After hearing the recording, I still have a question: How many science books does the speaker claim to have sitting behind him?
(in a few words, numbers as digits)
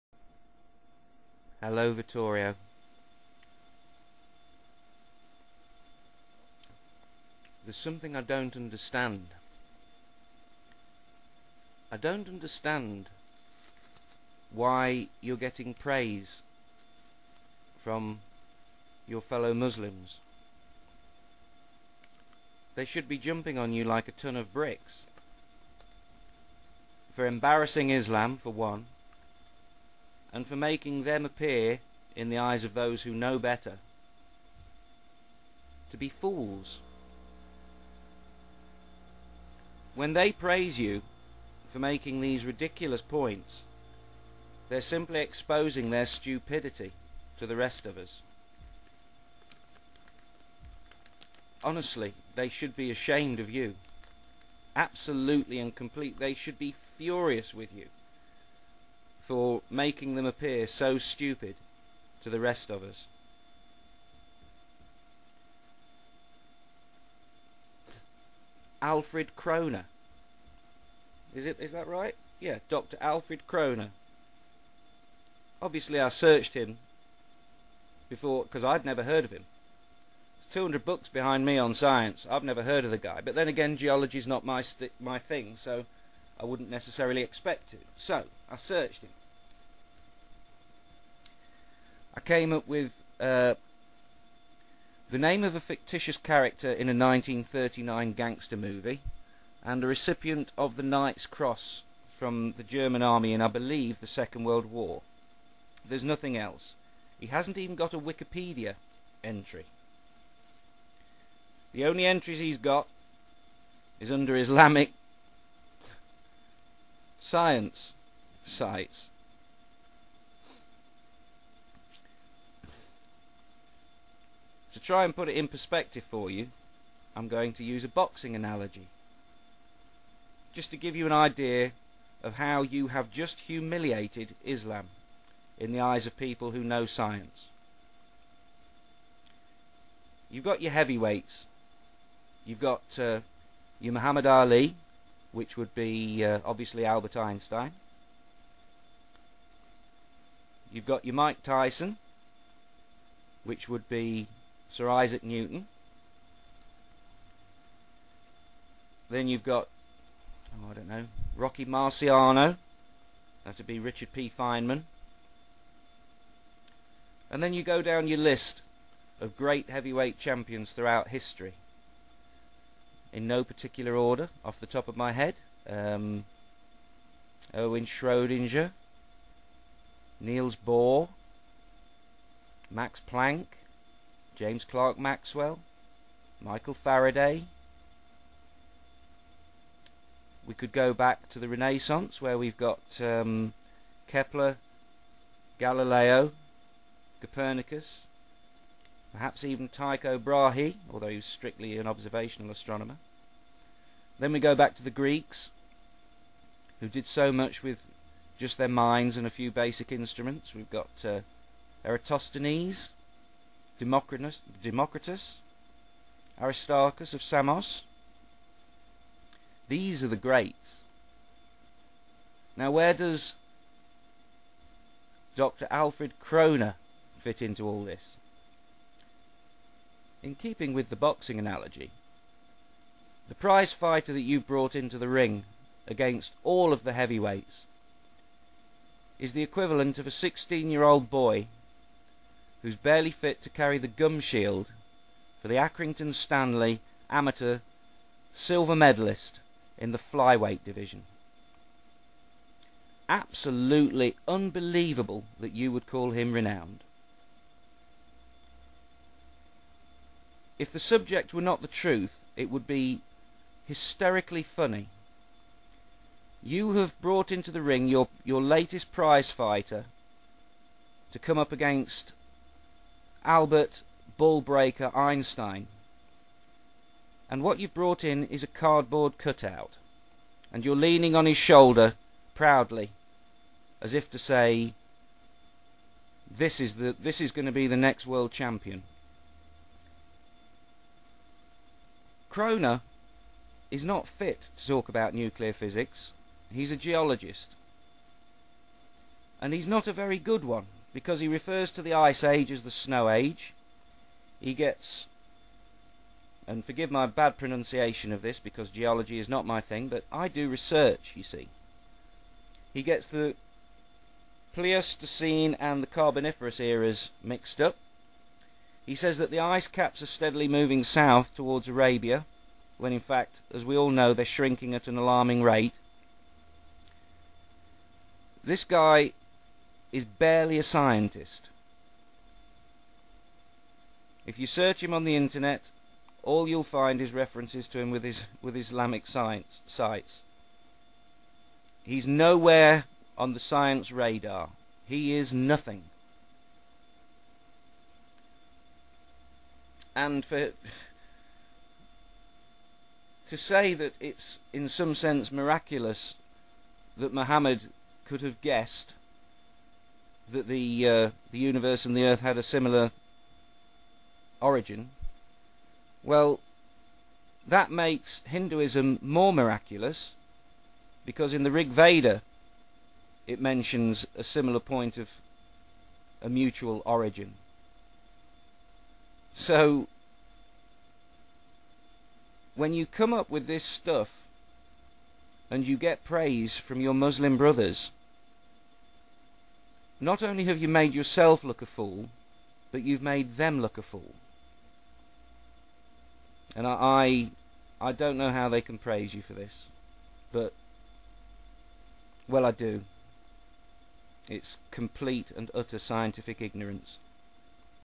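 200.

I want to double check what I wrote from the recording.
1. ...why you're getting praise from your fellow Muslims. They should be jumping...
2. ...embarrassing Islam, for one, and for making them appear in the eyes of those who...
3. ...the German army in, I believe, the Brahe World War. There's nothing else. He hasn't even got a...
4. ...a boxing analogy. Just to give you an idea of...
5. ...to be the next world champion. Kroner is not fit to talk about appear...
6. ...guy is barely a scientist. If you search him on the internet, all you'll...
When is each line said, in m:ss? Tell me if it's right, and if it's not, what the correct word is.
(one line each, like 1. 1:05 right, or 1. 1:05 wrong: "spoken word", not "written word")
1. 0:14 right
2. 0:27 right
3. 1:42 wrong: "Second", not "Brahe"
4. 2:07 right
5. 4:47 wrong: "nuclear", not "appear"
6. 5:28 right.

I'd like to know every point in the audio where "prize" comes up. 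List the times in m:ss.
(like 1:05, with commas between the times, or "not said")
3:53, 4:28.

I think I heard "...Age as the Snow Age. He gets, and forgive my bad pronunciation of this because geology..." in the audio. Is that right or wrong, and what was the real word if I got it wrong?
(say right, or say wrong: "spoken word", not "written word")
right.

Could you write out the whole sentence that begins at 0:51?
Honestly, they should be ashamed of you.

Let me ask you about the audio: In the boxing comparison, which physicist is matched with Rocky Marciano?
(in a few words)
Richard P. Feynman.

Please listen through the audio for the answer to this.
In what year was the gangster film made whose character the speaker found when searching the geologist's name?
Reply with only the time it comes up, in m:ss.
1:36.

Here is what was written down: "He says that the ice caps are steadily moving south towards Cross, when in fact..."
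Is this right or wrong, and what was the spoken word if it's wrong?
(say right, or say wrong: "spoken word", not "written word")
wrong: "Arabia", not "Cross".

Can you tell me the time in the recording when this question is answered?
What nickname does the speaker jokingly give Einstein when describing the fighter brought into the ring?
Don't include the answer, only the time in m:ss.
4:34.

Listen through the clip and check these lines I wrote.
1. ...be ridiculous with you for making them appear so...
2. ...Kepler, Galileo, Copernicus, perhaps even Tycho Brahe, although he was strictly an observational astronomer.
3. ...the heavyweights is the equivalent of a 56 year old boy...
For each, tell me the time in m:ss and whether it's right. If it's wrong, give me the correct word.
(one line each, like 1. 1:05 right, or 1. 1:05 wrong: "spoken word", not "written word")
1. 0:56 wrong: "furious", not "ridiculous"
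2. 3:14 right
3. 3:56 wrong: "16", not "56".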